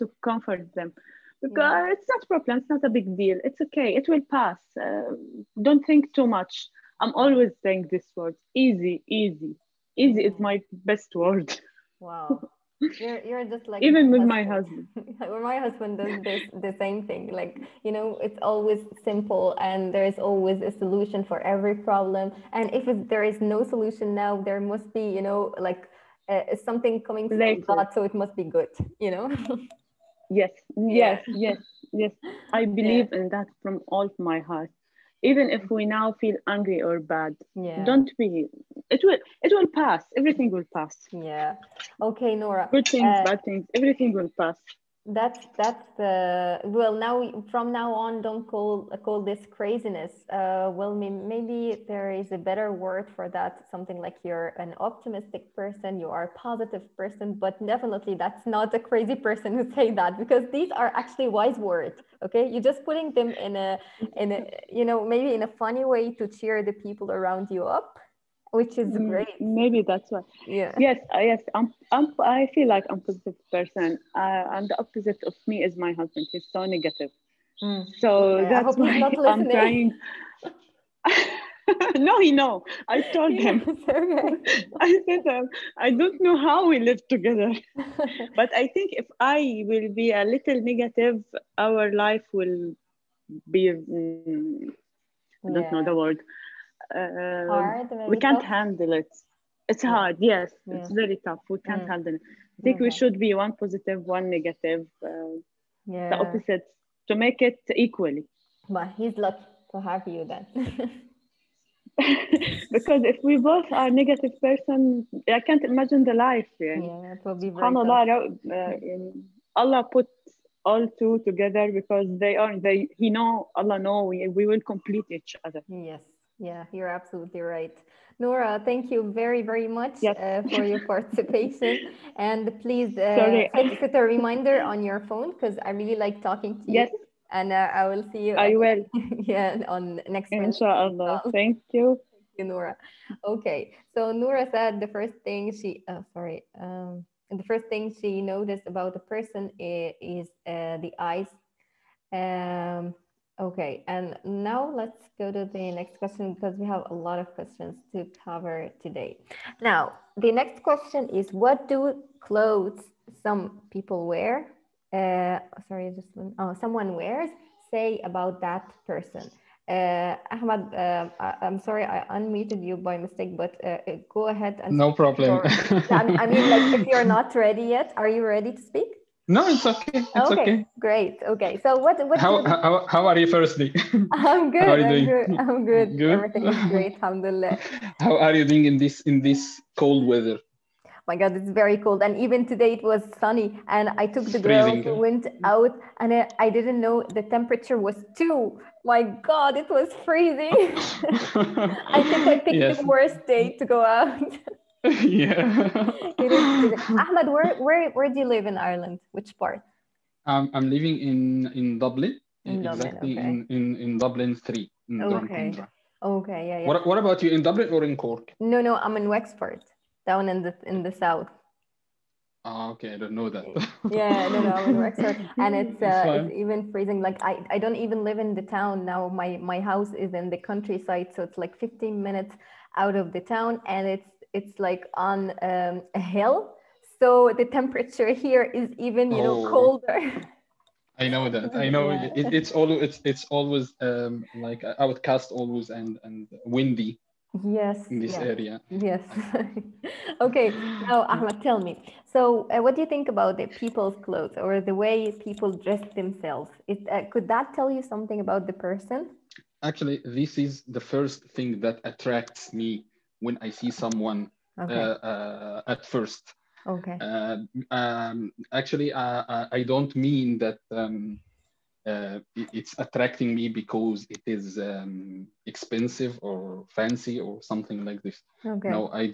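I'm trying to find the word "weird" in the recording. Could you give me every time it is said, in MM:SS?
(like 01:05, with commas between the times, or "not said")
not said.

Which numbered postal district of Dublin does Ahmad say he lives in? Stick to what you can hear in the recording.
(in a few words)
Dublin 3.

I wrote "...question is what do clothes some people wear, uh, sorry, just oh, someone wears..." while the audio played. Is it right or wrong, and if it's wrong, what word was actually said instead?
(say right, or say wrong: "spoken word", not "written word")
right.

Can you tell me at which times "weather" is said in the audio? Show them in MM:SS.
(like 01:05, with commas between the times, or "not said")
03:10.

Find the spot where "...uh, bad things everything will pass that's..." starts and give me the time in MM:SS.
00:43.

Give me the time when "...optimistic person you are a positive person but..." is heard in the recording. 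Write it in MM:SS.
00:54.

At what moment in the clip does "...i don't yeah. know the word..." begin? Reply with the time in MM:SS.
01:35.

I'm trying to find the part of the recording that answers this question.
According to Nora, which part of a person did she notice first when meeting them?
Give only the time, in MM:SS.
02:30.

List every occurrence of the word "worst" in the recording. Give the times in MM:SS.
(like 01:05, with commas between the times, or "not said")
03:22.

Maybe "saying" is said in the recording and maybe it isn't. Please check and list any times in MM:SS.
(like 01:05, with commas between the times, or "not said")
00:07.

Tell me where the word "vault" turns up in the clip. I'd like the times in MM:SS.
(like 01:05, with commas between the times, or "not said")
not said.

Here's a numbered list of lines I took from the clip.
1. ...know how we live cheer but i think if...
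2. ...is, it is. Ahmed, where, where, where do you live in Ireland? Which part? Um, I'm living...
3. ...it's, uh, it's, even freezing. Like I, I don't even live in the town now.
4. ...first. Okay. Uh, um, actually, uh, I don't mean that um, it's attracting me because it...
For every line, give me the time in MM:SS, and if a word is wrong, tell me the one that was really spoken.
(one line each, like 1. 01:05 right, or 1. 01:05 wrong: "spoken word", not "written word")
1. 01:26 wrong: "together", not "cheer"
2. 03:26 right
3. 03:45 right
4. 04:25 right.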